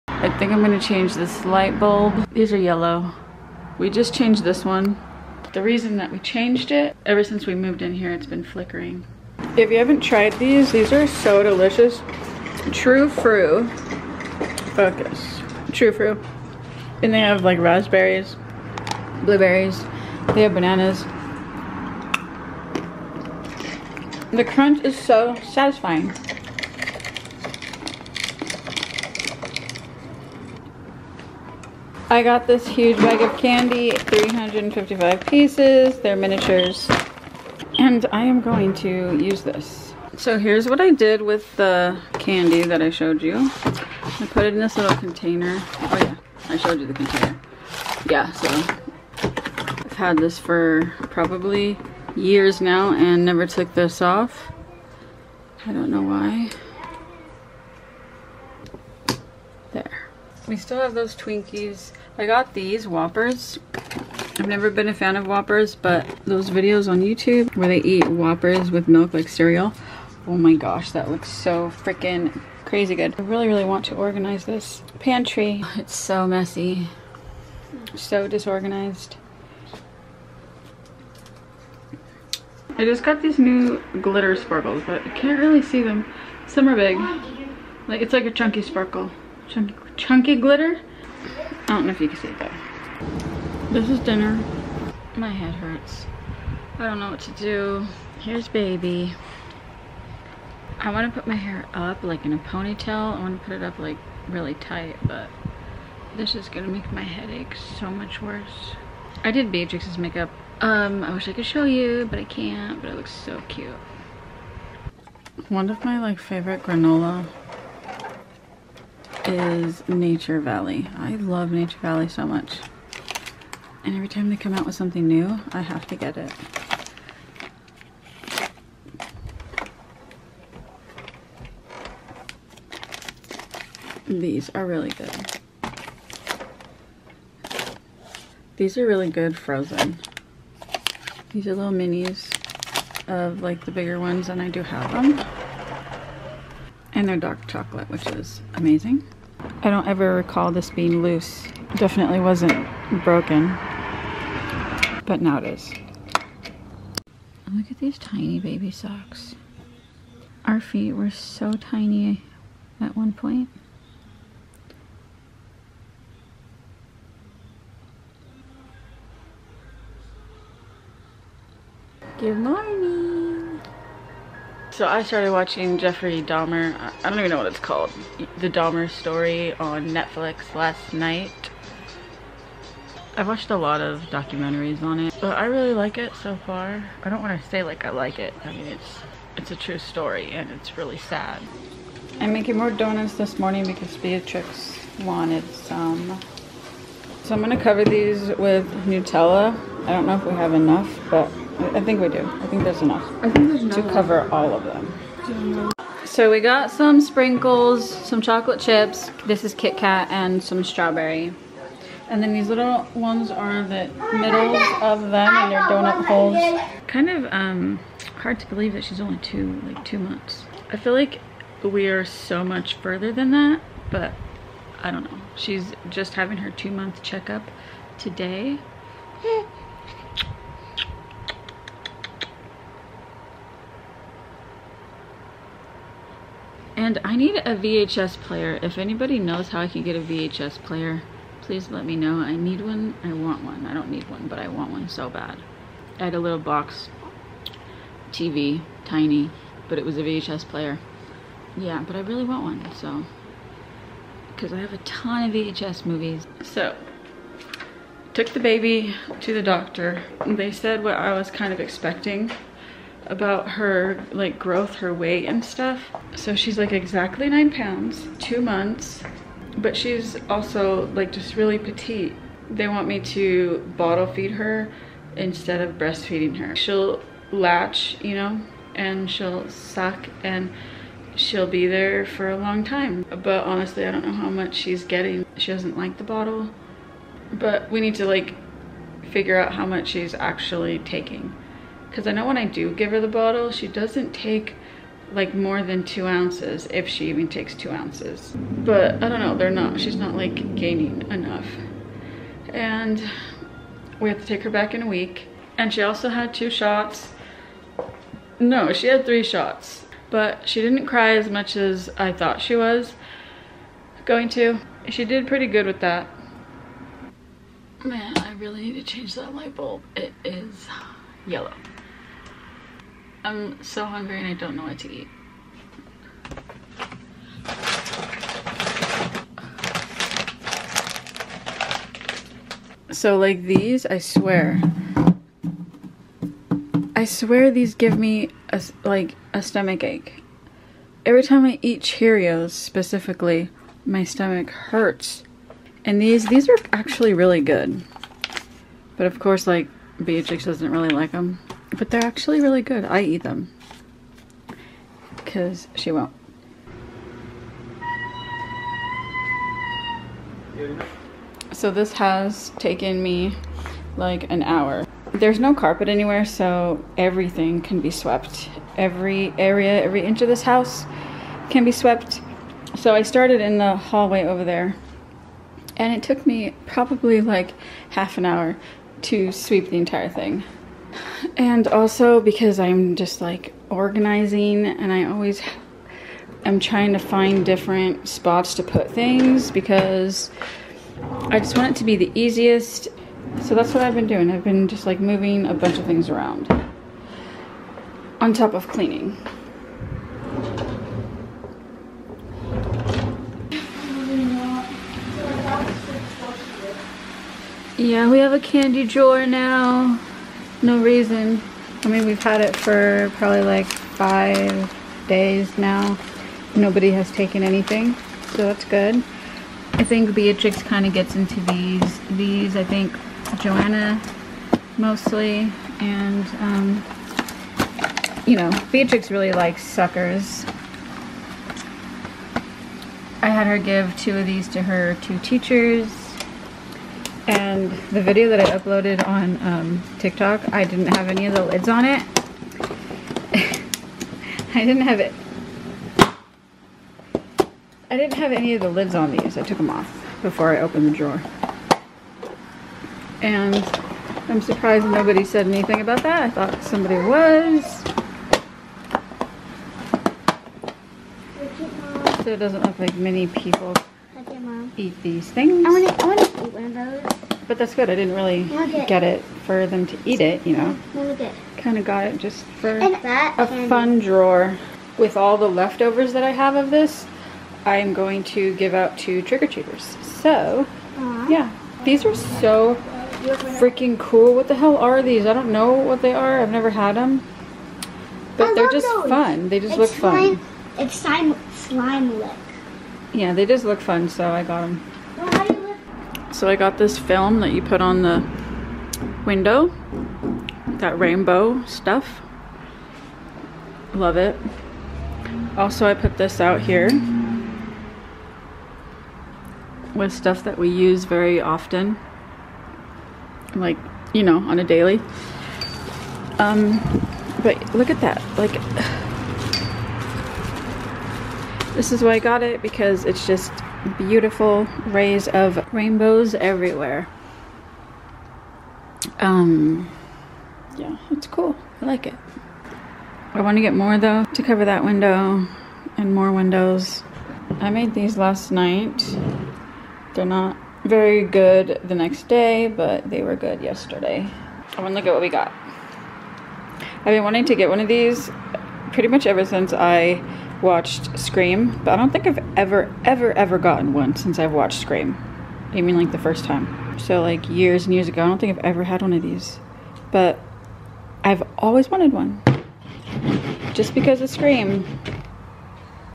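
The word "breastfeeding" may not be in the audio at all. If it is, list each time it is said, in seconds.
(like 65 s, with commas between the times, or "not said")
275 s.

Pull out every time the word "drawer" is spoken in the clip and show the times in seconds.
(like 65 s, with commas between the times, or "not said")
408 s, 450 s, 473 s.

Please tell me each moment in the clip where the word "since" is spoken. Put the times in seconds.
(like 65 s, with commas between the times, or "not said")
7 s, 549 s, 554 s.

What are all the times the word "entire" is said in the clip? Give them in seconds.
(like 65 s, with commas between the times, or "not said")
379 s.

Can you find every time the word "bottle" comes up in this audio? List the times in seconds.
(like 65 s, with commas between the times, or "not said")
273 s, 286 s, 293 s.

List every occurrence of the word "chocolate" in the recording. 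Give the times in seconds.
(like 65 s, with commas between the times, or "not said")
147 s, 208 s.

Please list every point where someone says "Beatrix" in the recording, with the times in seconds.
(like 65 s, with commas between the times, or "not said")
109 s, 193 s, 350 s, 420 s, 428 s.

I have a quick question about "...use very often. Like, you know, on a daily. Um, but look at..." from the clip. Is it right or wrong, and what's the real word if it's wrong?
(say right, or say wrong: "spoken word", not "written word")
right.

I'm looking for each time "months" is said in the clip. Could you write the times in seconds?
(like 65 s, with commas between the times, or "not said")
219 s, 226 s, 268 s.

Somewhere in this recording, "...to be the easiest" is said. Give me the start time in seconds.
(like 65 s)
391 s.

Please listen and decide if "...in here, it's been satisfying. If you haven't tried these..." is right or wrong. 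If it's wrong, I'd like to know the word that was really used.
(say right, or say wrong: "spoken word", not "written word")
wrong: "flickering", not "satisfying".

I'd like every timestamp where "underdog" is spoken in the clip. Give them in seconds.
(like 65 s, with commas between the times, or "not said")
not said.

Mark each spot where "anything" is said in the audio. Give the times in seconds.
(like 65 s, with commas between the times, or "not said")
417 s, 455 s.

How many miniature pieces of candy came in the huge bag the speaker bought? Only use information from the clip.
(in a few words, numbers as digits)
355.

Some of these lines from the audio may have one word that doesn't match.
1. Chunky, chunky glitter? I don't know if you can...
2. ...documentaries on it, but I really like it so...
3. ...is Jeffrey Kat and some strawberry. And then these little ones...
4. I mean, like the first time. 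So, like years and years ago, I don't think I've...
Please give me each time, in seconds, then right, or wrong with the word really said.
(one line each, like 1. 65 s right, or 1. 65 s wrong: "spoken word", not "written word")
1. 89 s right
2. 184 s right
3. 209 s wrong: "Kit", not "Jeffrey"
4. 555 s right.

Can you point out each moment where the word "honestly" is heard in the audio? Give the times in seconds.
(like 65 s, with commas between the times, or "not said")
283 s.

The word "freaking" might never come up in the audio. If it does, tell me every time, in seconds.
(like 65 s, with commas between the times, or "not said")
71 s, 483 s.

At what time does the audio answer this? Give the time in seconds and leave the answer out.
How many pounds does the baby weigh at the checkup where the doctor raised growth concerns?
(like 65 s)
267 s.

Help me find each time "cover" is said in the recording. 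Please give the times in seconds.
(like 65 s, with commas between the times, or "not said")
197 s, 203 s, 534 s.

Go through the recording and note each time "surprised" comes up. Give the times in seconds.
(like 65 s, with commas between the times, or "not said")
454 s.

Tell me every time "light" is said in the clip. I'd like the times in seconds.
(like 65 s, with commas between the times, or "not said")
1 s, 319 s.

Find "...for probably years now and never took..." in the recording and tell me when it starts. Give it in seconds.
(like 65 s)
50 s.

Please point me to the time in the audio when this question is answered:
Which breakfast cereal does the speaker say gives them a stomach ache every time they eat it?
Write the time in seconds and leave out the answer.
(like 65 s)
341 s.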